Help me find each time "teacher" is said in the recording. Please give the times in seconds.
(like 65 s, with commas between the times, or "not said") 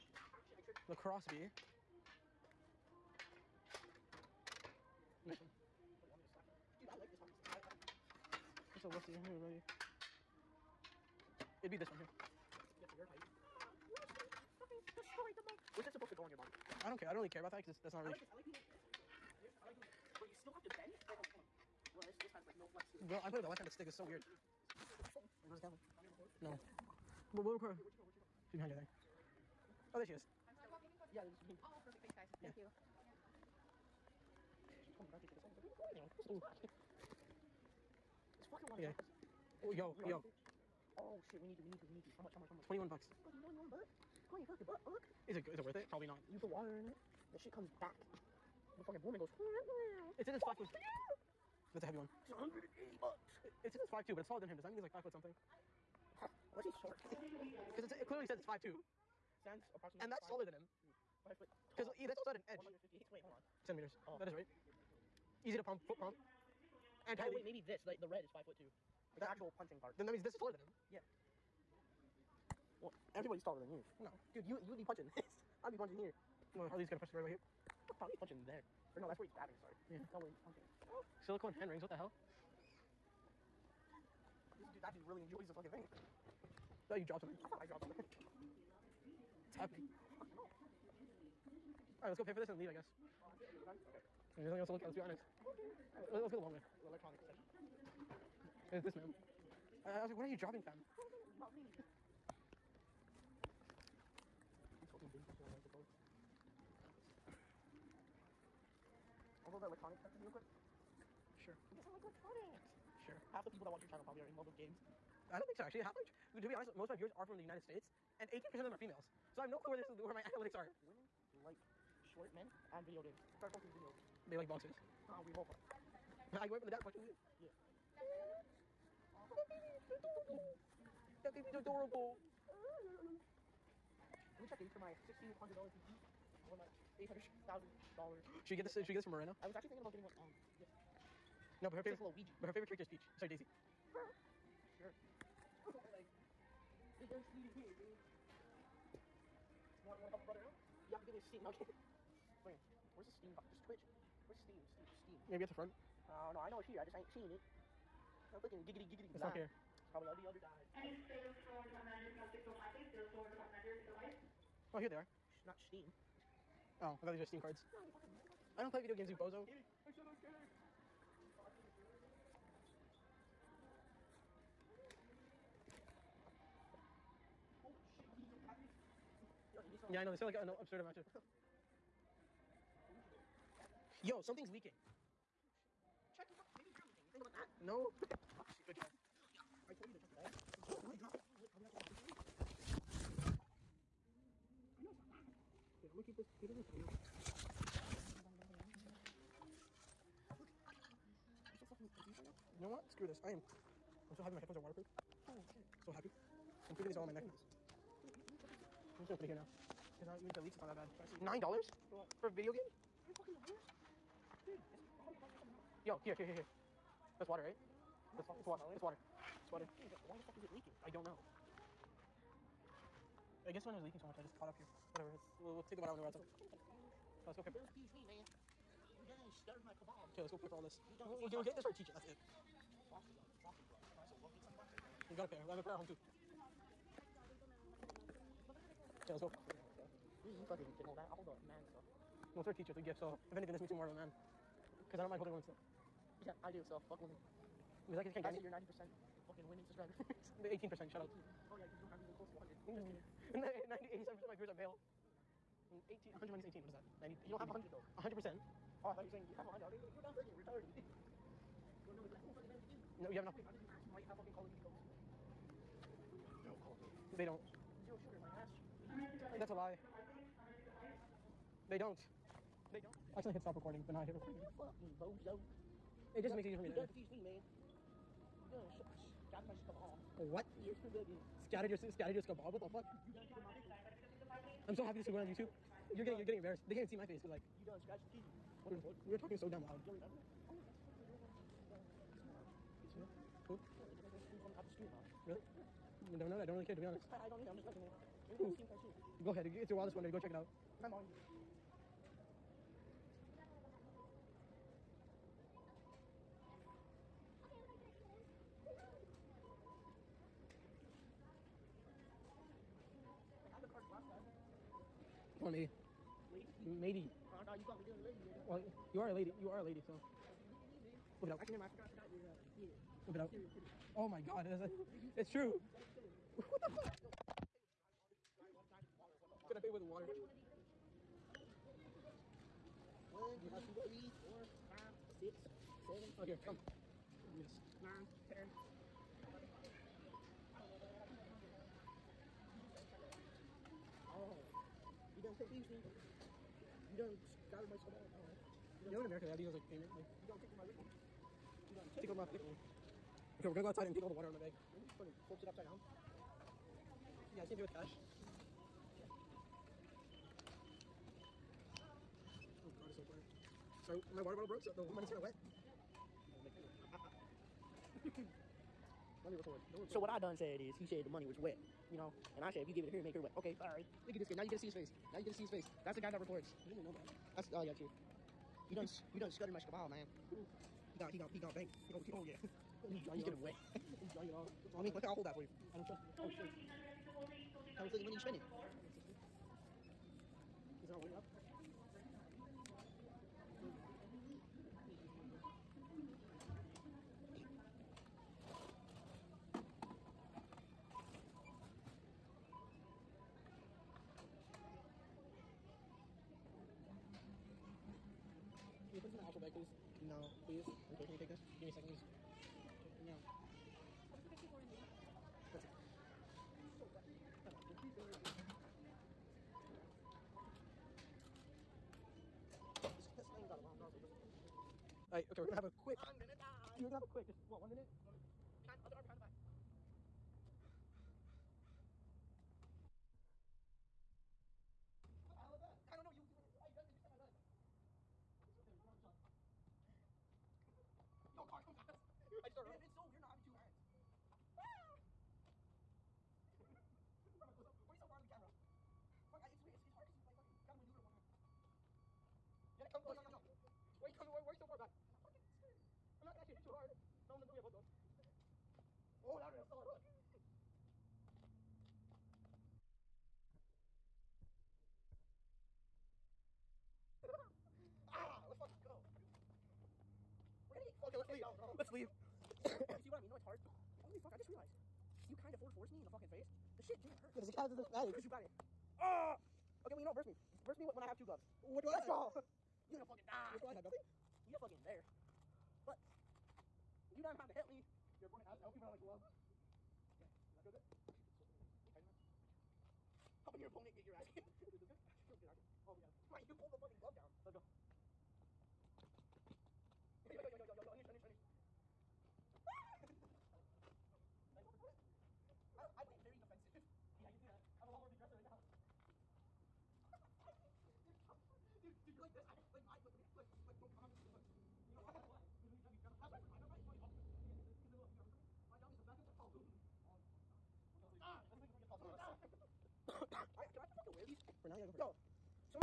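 231 s, 242 s.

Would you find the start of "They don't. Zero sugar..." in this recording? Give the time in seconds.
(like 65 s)
267 s.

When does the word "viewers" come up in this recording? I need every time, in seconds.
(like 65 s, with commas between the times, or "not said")
116 s, 254 s.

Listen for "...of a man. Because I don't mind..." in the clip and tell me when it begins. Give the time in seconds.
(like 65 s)
243 s.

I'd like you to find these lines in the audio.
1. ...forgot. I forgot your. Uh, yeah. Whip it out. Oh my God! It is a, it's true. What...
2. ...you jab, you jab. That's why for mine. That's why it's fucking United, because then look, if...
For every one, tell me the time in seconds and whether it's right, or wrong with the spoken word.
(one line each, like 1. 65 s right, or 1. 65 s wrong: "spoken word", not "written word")
1. 321 s right
2. 515 s wrong: "Yeah", not "United".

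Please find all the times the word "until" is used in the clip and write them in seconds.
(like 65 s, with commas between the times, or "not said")
457 s.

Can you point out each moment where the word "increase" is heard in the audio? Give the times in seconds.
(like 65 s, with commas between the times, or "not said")
not said.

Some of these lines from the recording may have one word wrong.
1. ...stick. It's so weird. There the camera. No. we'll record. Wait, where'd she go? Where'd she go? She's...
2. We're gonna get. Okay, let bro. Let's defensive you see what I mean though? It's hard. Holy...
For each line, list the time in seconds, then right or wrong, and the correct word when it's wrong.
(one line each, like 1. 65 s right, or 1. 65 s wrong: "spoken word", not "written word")
1. 23 s right
2. 470 s wrong: "leave", not "defensive".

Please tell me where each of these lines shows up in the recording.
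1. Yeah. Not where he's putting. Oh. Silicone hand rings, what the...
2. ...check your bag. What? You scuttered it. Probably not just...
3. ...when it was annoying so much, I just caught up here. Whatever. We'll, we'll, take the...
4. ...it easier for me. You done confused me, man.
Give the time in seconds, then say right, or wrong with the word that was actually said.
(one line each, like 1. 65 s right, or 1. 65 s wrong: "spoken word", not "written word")
1. 79 s wrong: "punching", not "putting"
2. 189 s wrong: "dropped", not "scuttered"
3. 223 s wrong: "leaking", not "annoying"
4. 276 s right.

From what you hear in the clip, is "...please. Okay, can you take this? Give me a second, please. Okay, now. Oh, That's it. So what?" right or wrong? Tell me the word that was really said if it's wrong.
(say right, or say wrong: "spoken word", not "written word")
right.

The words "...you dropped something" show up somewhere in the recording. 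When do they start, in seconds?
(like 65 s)
86 s.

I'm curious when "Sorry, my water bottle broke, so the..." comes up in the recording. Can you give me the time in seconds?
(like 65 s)
363 s.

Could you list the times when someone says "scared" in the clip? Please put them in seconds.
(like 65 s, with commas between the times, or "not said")
280 s, 455 s.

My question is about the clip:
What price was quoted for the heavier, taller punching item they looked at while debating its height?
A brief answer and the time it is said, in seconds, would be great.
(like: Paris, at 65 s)
$180, at 52 s.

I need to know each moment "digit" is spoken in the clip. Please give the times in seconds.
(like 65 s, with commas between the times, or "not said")
not said.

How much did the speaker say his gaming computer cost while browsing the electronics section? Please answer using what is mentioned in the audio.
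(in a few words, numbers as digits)
$1,600.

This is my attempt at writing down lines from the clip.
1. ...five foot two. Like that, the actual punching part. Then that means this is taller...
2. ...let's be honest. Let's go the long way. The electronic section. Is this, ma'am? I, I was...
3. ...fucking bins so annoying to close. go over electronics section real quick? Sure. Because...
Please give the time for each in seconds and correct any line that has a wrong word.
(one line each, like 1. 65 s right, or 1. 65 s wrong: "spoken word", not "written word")
1. 68 s right
2. 94 s right
3. 104 s right.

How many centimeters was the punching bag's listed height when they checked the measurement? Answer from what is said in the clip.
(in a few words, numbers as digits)
158.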